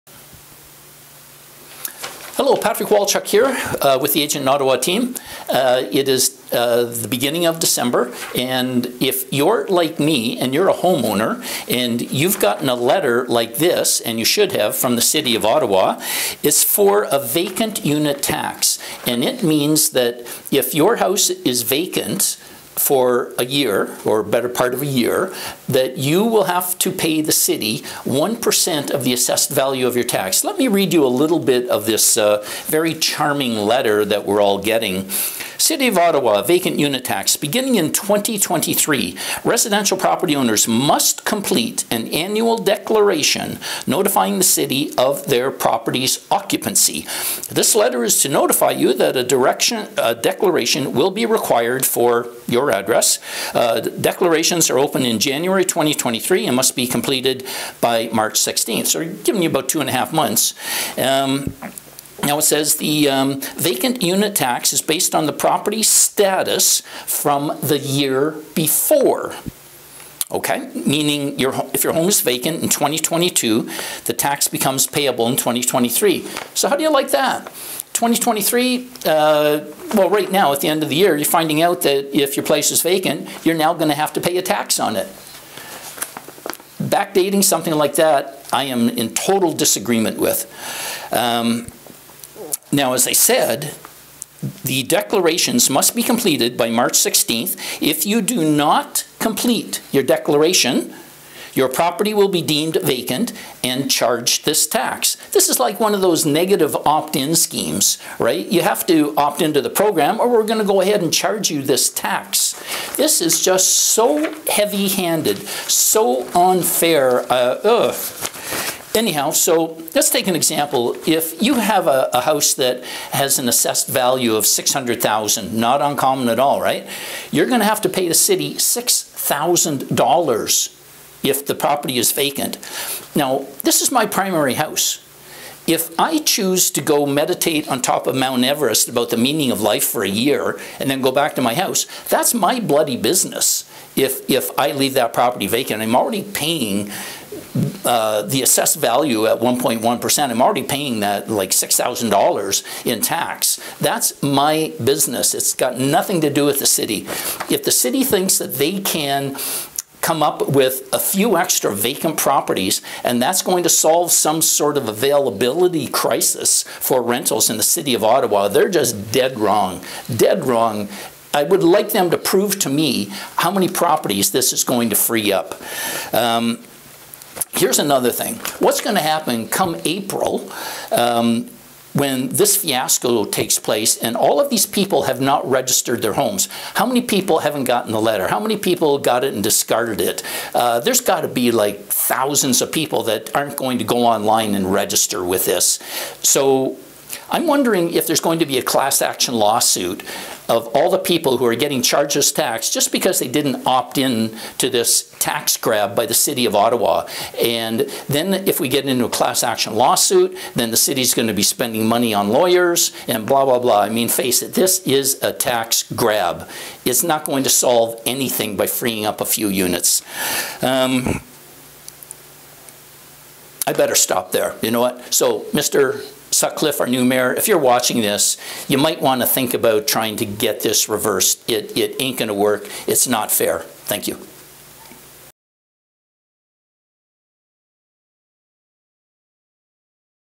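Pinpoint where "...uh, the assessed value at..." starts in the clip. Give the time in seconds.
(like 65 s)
147 s.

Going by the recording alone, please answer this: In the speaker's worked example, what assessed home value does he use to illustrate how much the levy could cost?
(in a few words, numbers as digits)
600000.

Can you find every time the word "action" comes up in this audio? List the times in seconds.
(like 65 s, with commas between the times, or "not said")
199 s, 209 s.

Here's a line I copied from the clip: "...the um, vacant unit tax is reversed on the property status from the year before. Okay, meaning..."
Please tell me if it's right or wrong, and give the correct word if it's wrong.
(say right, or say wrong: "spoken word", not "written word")
wrong: "based", not "reversed".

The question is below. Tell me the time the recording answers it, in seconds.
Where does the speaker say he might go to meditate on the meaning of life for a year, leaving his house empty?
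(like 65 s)
138 s.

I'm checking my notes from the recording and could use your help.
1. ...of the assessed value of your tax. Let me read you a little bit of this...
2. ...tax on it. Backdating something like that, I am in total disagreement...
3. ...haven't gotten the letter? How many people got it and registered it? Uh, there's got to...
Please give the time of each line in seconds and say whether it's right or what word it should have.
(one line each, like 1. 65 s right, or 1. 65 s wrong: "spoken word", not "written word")
1. 28 s right
2. 84 s right
3. 187 s wrong: "discarded", not "registered".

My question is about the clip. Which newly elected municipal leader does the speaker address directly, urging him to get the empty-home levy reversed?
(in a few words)
Mr. Sutcliffe.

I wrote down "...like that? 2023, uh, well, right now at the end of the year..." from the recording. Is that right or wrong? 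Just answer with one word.
right.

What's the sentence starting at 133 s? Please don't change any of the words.
Now, this is my primary house.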